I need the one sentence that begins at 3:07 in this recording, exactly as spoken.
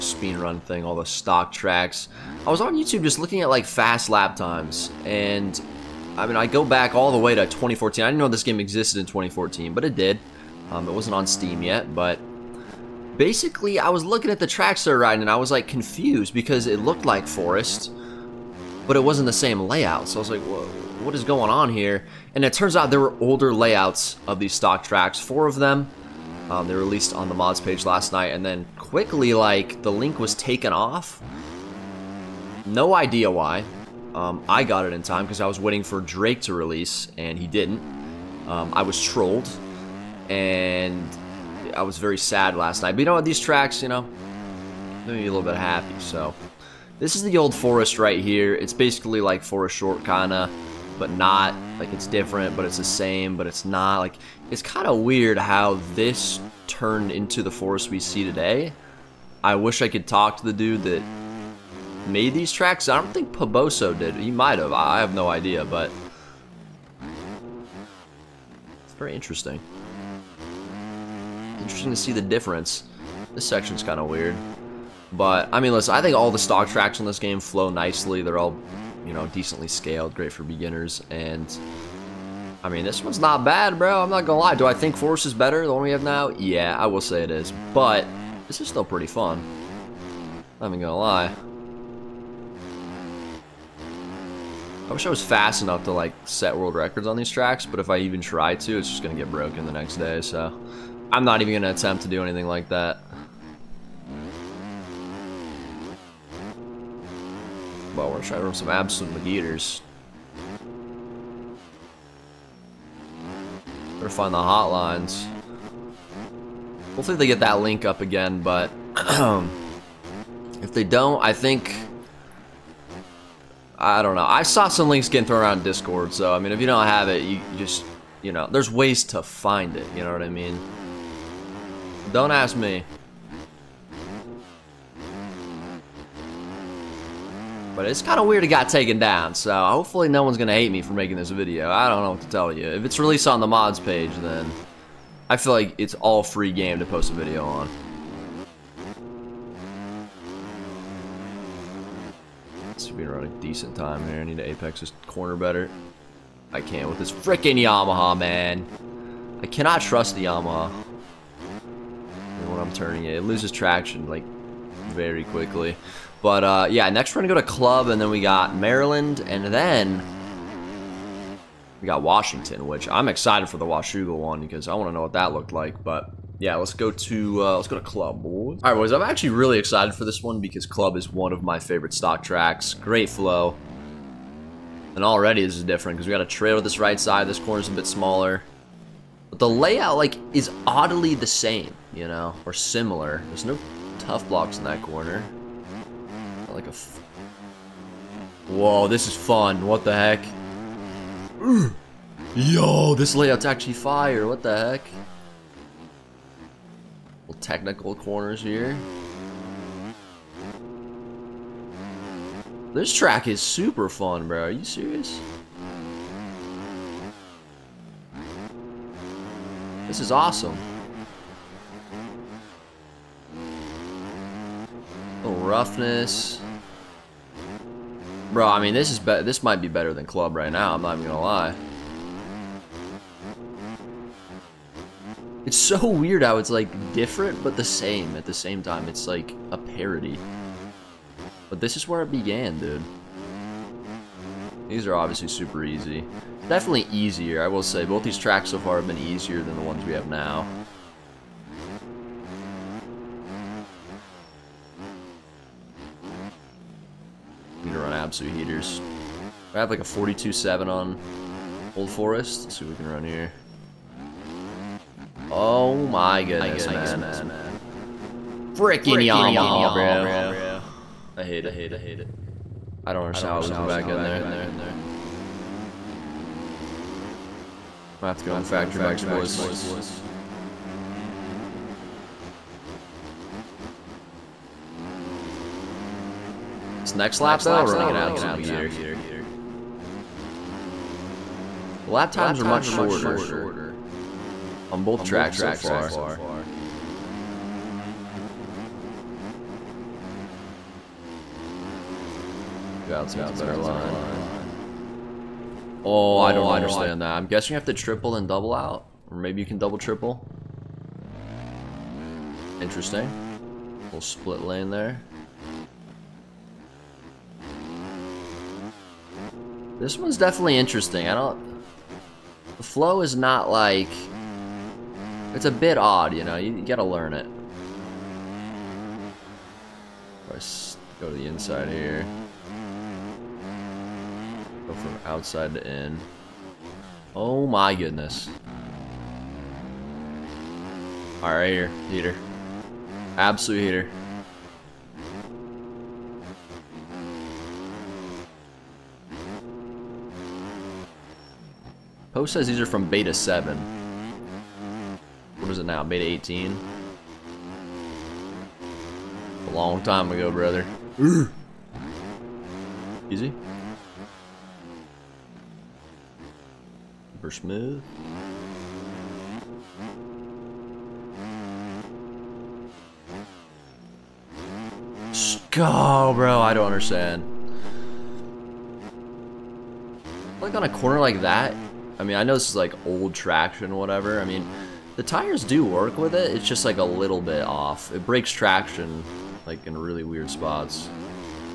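This corner's a bit smaller the layout like is oddly the same, you know, or similar.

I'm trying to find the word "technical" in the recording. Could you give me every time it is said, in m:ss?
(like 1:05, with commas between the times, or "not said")
3:27.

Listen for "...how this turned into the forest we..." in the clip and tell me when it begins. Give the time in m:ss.
0:55.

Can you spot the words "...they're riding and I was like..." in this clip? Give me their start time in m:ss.
0:14.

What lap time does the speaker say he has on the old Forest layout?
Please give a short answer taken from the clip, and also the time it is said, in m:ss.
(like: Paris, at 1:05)
42-7, at 4:19.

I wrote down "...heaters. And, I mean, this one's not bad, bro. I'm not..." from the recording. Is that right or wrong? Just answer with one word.
wrong.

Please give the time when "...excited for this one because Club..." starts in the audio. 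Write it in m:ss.
2:59.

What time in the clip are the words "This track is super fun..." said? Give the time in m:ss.
3:32.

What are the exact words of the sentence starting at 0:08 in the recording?
I didn't know this game existed in 2014, but it did.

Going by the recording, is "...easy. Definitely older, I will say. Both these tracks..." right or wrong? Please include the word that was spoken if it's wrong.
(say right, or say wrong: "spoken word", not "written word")
wrong: "easier", not "older".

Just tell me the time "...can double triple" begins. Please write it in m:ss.
5:09.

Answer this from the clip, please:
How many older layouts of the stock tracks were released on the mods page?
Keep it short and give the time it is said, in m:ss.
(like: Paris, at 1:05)
4, at 0:25.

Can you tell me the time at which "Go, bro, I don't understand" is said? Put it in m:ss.
6:15.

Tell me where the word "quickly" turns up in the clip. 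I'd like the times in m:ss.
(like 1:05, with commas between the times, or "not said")
0:28, 2:45.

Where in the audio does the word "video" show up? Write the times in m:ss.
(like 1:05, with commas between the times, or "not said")
2:21, 2:27.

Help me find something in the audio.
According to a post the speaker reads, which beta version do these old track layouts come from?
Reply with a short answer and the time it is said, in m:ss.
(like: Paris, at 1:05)
Beta 7, at 5:52.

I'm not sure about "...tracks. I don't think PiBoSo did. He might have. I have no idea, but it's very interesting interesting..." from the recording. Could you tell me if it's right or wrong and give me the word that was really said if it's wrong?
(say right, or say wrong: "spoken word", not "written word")
right.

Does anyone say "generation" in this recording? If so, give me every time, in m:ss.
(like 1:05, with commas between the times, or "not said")
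not said.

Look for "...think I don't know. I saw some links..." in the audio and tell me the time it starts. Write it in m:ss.
2:01.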